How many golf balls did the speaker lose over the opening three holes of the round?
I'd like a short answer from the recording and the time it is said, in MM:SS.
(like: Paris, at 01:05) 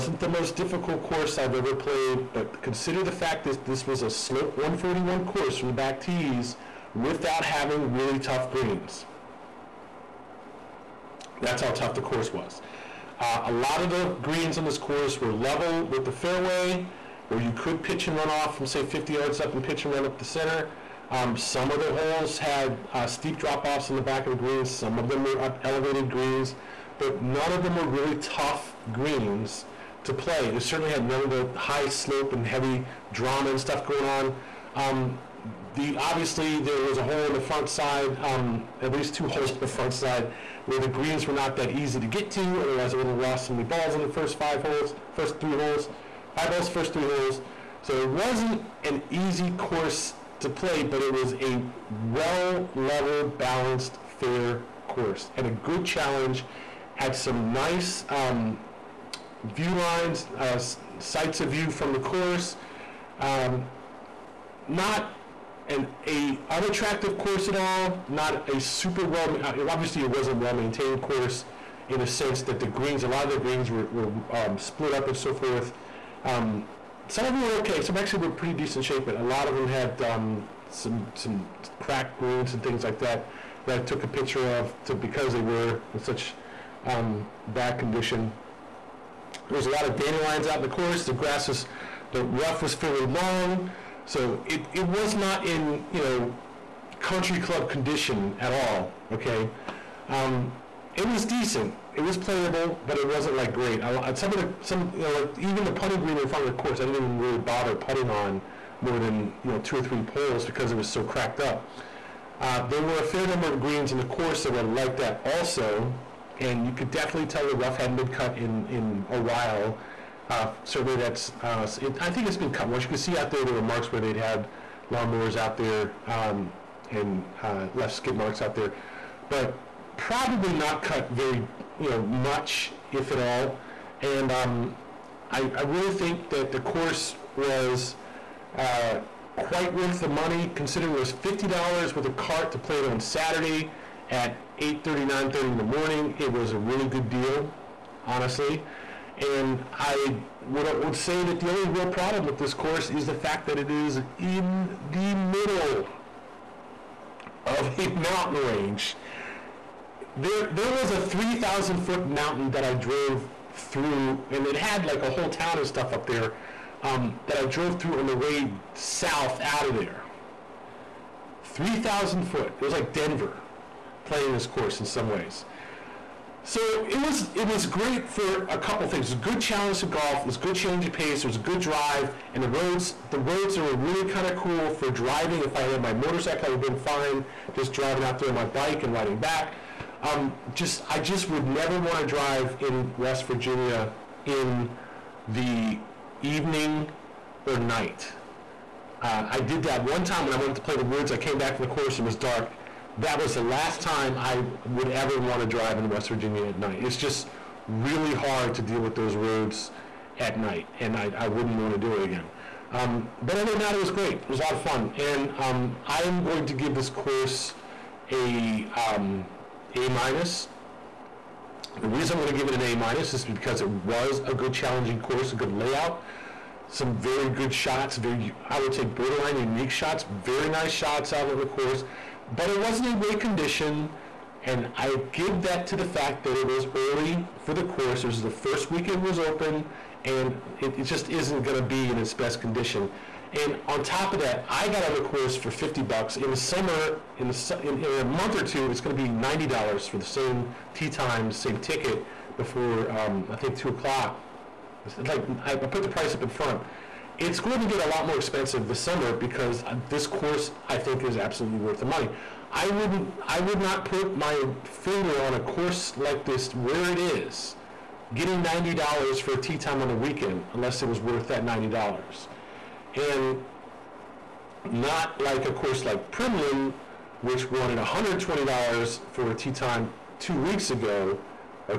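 5, at 00:46.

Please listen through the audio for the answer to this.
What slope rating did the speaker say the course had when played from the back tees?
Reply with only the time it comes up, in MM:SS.
00:04.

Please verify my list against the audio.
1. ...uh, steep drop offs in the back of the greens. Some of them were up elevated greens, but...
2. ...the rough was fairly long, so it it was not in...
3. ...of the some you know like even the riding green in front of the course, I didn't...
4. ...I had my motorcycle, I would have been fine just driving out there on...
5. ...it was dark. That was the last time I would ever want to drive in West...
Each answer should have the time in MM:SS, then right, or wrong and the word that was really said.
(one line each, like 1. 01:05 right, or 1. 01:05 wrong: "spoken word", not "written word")
1. 00:22 right
2. 01:32 right
3. 01:44 wrong: "putting", not "riding"
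4. 03:05 right
5. 03:22 right.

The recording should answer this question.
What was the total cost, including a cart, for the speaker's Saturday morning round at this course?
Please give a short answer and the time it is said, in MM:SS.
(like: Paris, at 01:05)
$50, at 02:21.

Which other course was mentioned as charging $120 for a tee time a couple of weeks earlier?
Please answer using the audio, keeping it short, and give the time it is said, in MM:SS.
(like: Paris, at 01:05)
Primland, at 04:36.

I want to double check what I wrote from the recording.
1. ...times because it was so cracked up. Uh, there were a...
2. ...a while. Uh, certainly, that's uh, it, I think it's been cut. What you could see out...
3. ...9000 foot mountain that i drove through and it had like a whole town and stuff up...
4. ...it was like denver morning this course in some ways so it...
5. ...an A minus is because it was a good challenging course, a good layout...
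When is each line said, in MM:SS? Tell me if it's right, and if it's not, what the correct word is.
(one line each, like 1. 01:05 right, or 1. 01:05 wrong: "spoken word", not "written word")
1. 01:50 wrong: "poles", not "times"
2. 01:59 right
3. 02:40 wrong: "3000", not "9000"
4. 02:52 wrong: "playing", not "morning"
5. 03:42 right.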